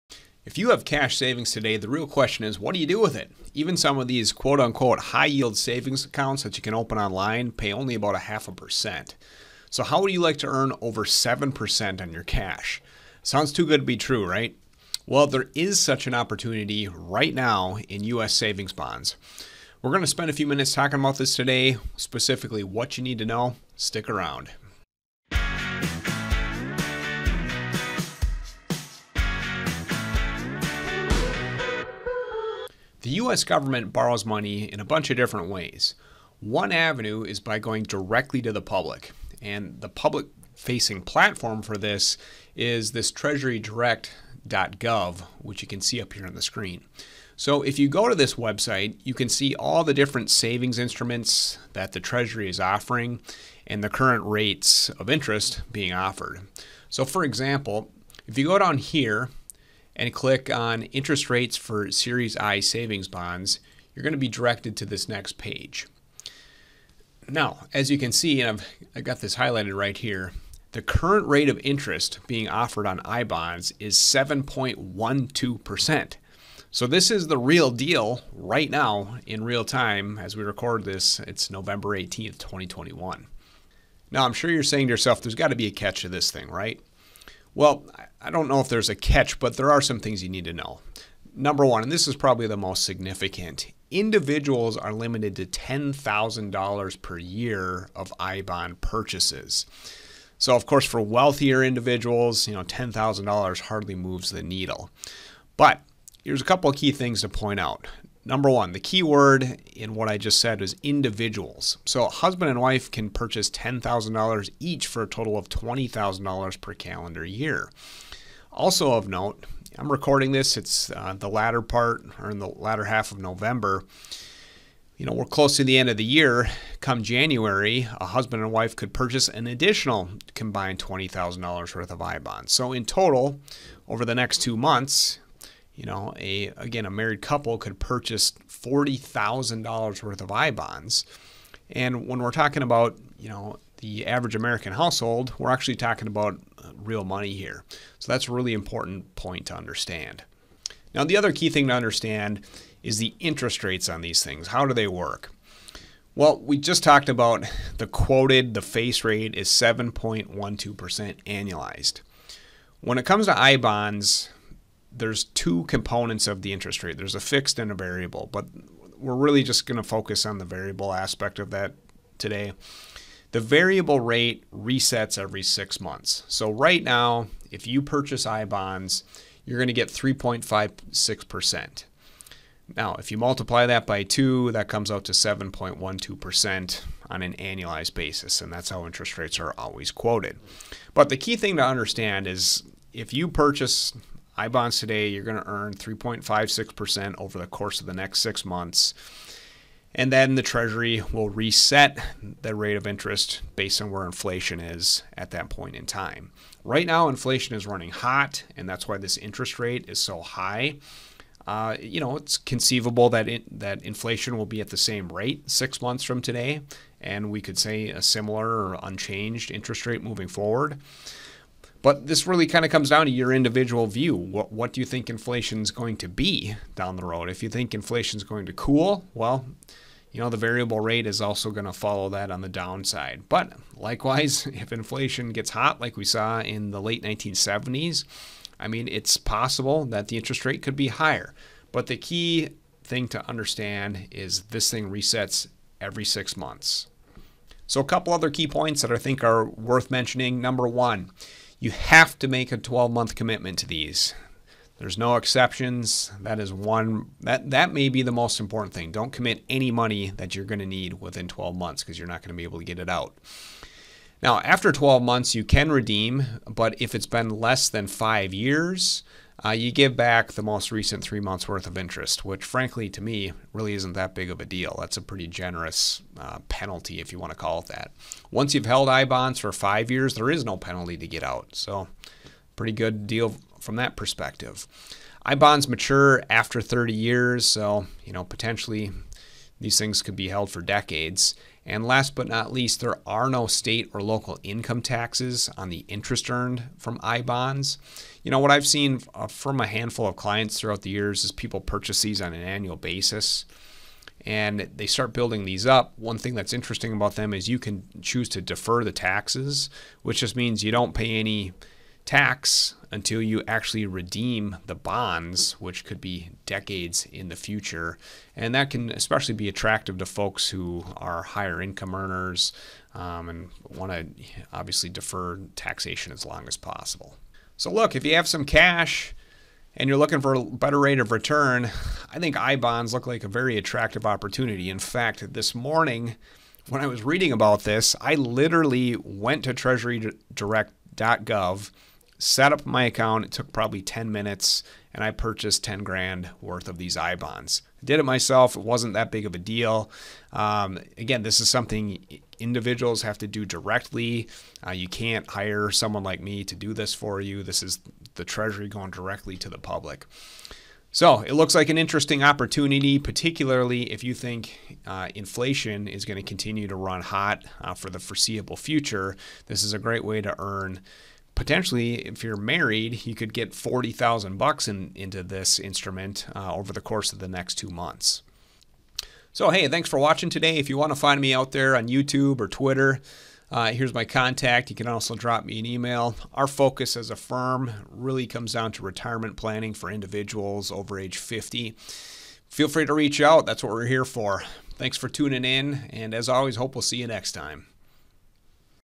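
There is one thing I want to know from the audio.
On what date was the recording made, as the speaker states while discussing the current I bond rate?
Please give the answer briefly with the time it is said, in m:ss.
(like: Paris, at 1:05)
November 18th, 2021, at 1:21.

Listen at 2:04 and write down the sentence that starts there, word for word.
You know, we're close to the end of the year.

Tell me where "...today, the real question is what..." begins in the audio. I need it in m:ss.
0:01.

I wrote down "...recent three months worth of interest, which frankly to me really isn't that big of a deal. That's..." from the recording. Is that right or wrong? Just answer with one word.
right.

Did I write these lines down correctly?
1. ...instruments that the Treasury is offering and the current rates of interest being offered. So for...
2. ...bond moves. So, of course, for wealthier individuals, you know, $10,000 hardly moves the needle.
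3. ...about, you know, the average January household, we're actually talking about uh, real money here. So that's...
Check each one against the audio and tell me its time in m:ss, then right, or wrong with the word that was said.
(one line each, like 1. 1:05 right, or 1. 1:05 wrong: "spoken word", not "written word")
1. 0:50 right
2. 1:38 wrong: "purchases", not "moves"
3. 2:22 wrong: "American", not "January".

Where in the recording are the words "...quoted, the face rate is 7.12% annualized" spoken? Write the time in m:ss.
2:37.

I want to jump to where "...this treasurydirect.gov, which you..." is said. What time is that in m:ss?
0:42.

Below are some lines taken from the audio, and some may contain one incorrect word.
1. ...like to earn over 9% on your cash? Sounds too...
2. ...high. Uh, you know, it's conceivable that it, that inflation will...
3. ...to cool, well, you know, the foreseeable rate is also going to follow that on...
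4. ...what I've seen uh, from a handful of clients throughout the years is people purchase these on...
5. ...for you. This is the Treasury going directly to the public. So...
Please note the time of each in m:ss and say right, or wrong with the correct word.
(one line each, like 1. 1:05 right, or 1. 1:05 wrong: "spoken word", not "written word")
1. 0:10 wrong: "7", not "9"
2. 3:30 right
3. 3:48 wrong: "variable", not "foreseeable"
4. 4:58 right
5. 5:56 right.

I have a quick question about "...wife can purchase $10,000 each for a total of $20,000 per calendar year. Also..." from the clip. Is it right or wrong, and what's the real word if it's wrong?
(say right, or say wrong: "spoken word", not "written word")
right.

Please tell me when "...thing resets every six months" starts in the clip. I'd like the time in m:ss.
4:04.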